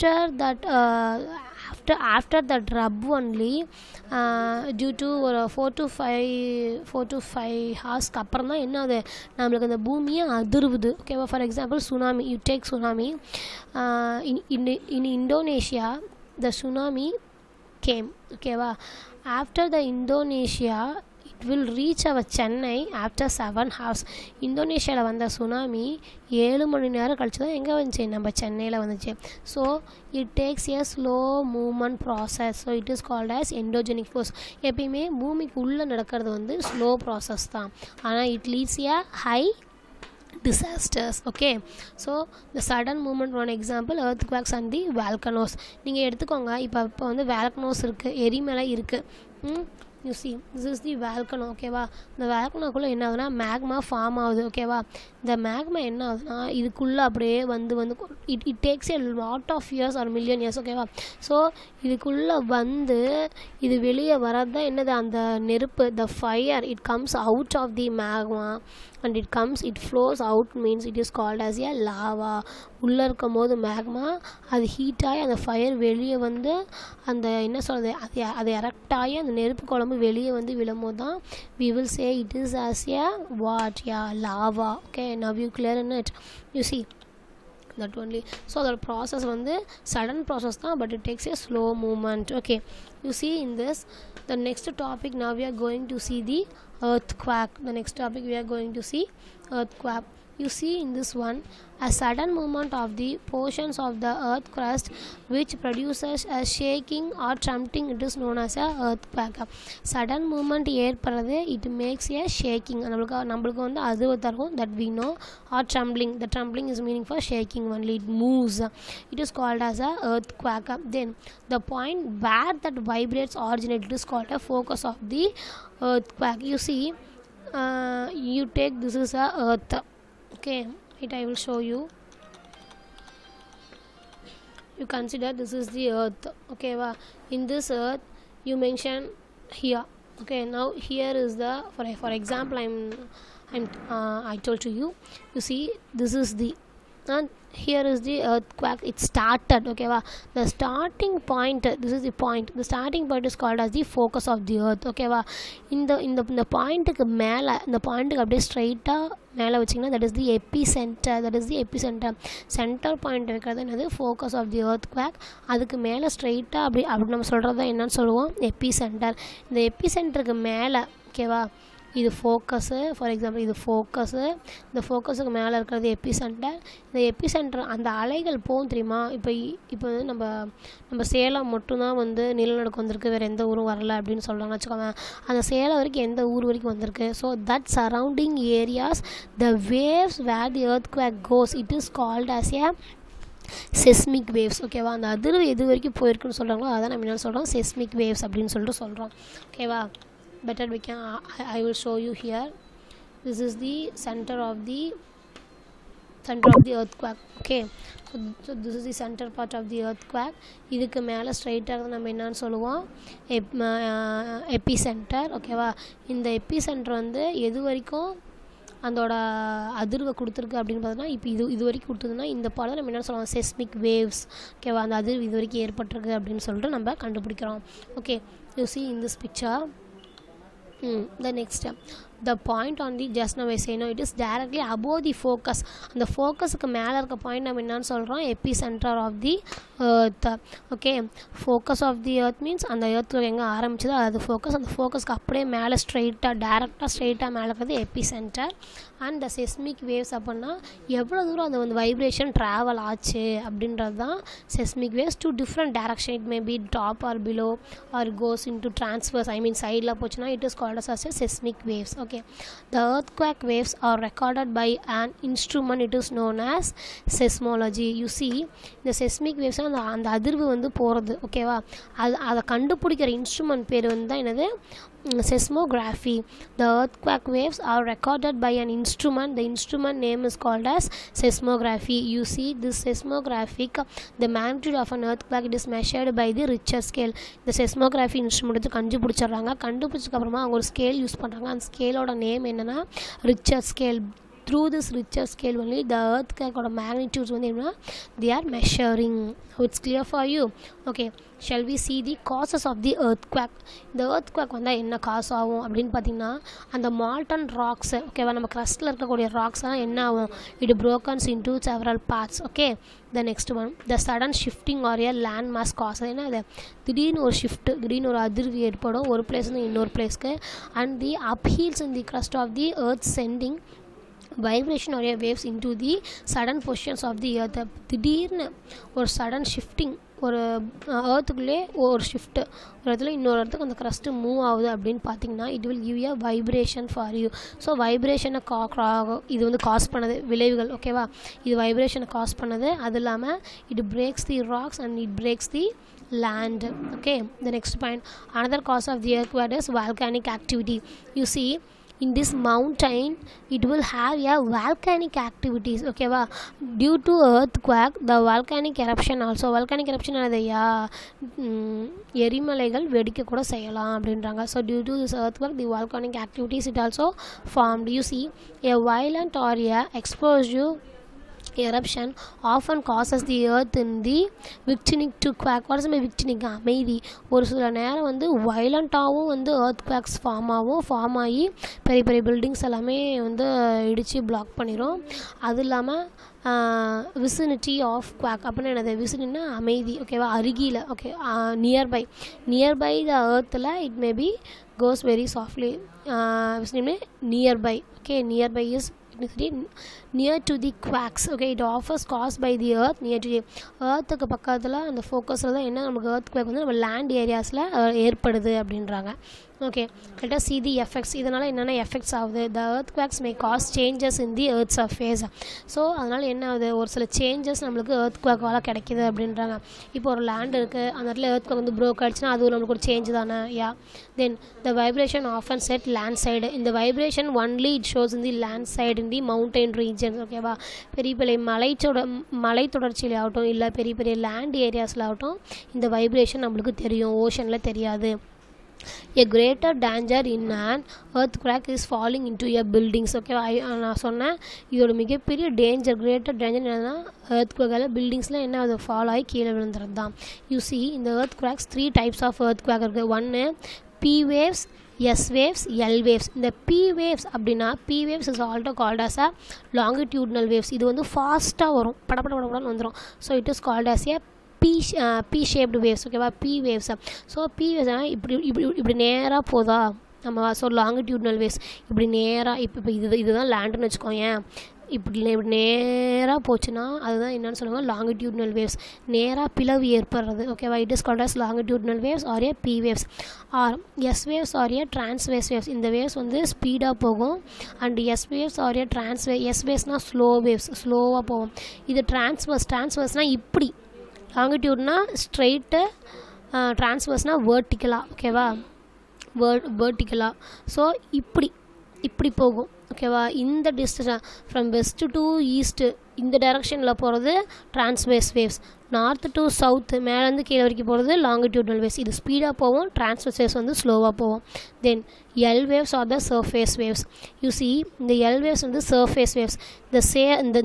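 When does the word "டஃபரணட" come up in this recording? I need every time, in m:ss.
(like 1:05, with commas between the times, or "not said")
4:15.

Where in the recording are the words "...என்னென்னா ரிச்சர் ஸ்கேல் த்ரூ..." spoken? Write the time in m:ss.
4:52.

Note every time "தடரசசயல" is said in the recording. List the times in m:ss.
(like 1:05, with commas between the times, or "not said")
7:12.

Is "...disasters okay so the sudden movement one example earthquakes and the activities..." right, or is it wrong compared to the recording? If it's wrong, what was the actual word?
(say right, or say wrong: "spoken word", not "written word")
wrong: "volcanoes", not "activities".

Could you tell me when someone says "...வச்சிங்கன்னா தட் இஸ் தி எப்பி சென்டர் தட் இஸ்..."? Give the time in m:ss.
2:39.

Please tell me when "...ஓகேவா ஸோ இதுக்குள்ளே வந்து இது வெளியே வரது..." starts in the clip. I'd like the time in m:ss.
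1:00.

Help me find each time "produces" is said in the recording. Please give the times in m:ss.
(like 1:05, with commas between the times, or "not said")
1:45.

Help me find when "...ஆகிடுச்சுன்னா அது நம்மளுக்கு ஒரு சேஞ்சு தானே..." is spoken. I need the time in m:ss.
7:02.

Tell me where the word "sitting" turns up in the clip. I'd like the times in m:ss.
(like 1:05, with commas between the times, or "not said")
not said.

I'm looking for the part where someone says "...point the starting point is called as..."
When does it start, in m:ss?
2:32.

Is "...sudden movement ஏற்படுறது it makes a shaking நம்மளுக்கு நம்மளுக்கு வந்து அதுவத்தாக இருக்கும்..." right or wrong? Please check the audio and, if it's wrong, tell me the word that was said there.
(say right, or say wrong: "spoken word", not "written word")
right.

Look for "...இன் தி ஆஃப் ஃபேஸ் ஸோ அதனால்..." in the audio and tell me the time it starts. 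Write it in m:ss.
6:54.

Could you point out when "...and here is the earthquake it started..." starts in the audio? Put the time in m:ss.
2:27.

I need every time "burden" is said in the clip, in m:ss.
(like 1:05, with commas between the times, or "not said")
not said.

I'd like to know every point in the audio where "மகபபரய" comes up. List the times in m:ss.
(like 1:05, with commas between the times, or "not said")
7:25.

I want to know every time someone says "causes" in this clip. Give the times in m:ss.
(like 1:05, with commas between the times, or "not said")
6:12.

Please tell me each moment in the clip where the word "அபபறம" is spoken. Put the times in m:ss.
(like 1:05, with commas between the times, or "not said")
0:08.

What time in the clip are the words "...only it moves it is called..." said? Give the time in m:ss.
1:57.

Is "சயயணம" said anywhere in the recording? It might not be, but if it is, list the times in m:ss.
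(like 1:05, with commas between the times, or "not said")
3:53.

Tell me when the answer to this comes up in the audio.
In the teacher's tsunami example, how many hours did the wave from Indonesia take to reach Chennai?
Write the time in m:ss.
0:23.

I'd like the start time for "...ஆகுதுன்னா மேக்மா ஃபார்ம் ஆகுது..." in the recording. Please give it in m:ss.
0:53.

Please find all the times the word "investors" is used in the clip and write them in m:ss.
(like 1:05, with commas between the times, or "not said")
not said.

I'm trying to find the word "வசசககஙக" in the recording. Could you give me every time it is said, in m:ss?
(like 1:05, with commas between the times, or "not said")
3:04, 7:53.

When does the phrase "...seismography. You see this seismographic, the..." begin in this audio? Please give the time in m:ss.
4:41.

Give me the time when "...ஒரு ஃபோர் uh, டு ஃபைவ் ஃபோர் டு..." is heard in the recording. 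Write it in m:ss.
0:05.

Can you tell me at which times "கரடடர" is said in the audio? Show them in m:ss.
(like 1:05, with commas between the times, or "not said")
7:19, 7:26.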